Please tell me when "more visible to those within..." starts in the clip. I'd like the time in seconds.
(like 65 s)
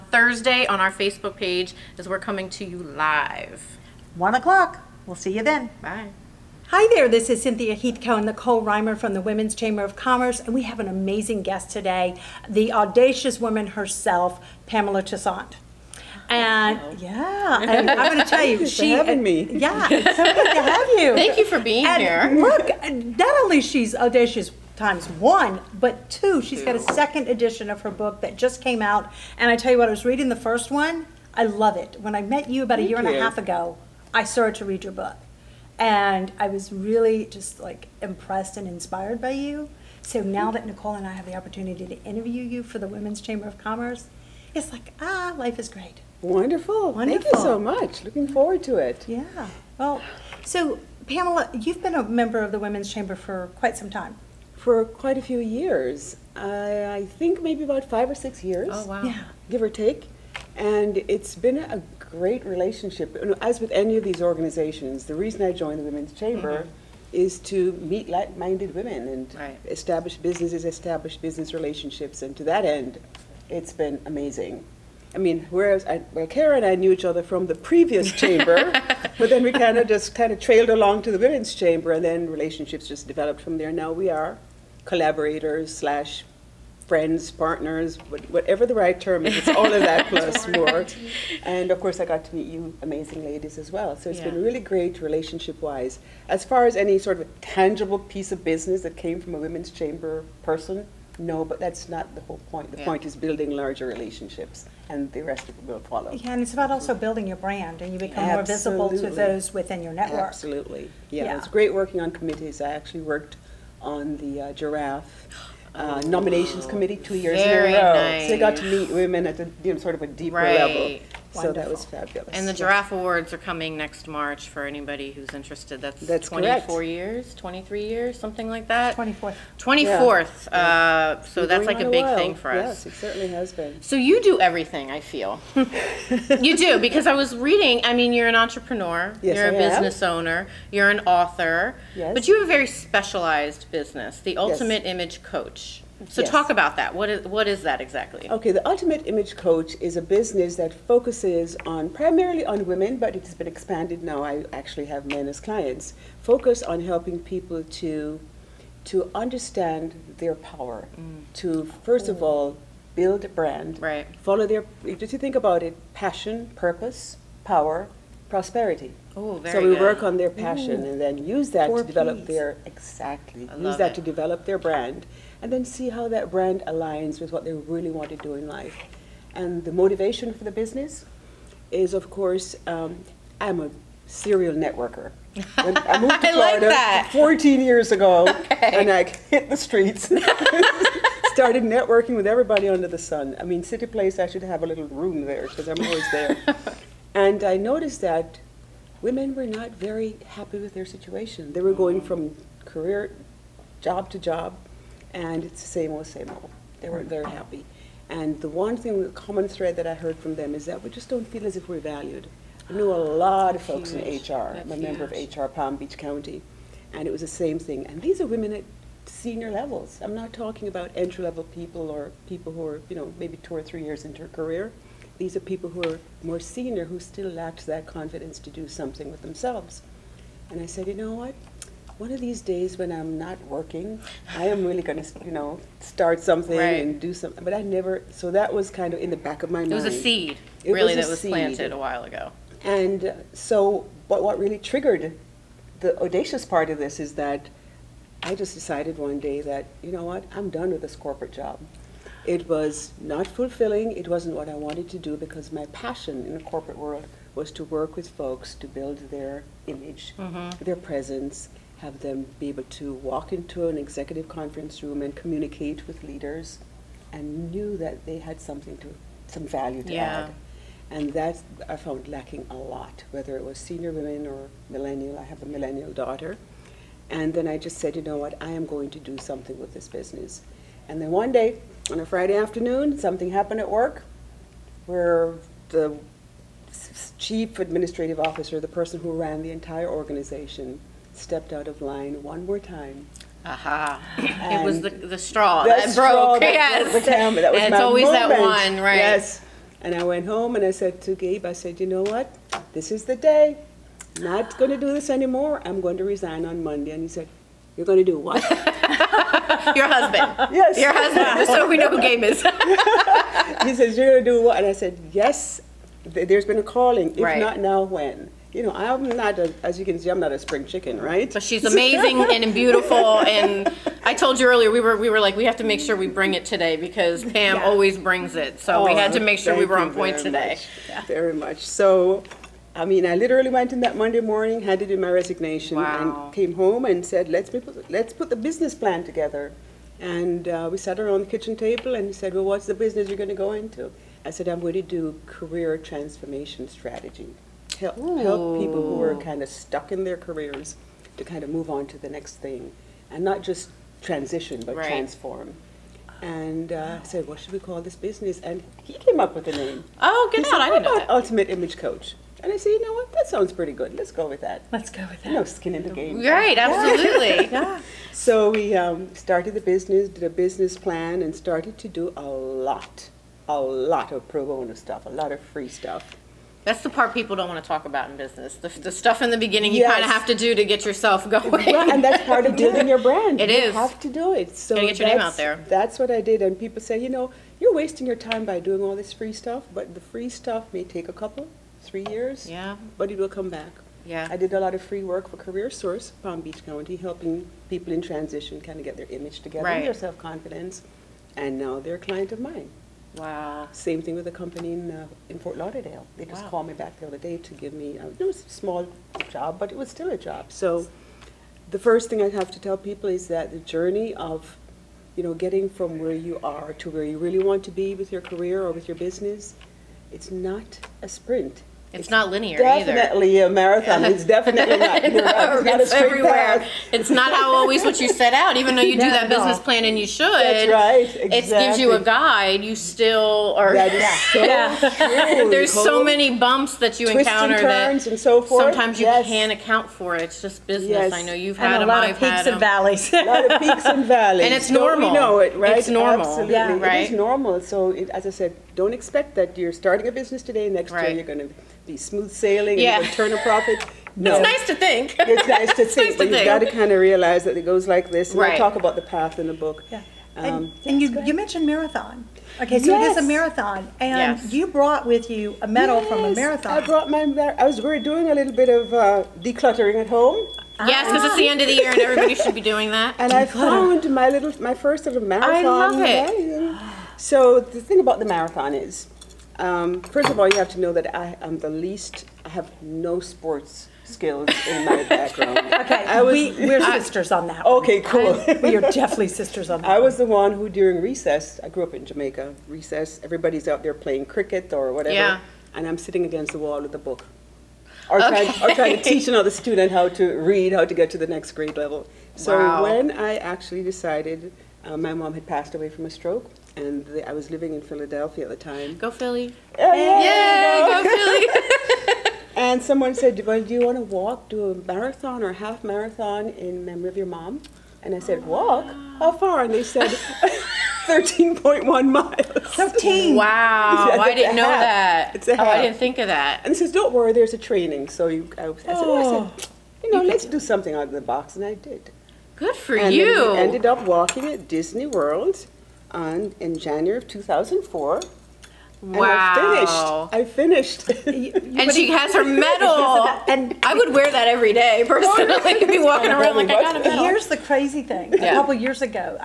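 108 s.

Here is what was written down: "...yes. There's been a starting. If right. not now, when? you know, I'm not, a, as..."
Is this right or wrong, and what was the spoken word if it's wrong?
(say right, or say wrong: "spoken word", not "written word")
wrong: "calling", not "starting".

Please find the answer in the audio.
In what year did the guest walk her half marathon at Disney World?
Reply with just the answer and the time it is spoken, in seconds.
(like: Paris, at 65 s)
2004, at 537 s.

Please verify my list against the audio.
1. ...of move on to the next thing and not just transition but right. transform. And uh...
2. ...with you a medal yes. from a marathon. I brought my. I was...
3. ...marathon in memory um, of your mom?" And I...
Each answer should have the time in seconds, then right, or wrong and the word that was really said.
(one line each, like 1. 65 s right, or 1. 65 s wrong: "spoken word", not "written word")
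1. 351 s right
2. 465 s right
3. 515 s right.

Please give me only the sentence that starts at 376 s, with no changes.
That's the part people don't want to talk about in business.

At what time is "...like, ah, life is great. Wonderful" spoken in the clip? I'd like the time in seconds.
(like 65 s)
44 s.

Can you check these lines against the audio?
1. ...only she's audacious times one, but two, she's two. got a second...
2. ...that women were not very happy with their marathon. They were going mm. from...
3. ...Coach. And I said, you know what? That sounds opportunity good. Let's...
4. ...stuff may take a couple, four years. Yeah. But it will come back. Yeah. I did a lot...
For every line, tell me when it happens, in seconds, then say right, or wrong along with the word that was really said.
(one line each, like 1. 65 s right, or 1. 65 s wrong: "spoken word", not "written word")
1. 23 s right
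2. 198 s wrong: "situation", not "marathon"
3. 361 s wrong: "pretty", not "opportunity"
4. 390 s wrong: "three", not "four".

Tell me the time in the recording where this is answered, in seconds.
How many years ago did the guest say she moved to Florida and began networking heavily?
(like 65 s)
187 s.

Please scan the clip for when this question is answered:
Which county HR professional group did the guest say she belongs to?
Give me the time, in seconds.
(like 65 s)
215 s.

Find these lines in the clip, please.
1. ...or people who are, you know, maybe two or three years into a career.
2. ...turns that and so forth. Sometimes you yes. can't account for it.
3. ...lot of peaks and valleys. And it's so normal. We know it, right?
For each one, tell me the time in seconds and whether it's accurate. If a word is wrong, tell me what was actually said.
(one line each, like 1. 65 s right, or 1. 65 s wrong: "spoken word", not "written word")
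1. 221 s right
2. 437 s right
3. 443 s right.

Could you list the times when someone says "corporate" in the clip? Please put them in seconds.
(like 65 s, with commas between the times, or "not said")
250 s, 256 s.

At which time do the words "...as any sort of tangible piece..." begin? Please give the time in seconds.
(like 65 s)
96 s.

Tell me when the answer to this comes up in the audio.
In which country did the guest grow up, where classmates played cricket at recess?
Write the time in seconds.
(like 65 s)
492 s.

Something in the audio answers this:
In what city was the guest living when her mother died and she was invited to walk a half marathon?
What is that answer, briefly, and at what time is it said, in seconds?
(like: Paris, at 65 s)
Philadelphia, at 507 s.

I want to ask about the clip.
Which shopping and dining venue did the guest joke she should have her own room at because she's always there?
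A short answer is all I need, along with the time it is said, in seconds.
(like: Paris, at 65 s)
CityPlace, at 193 s.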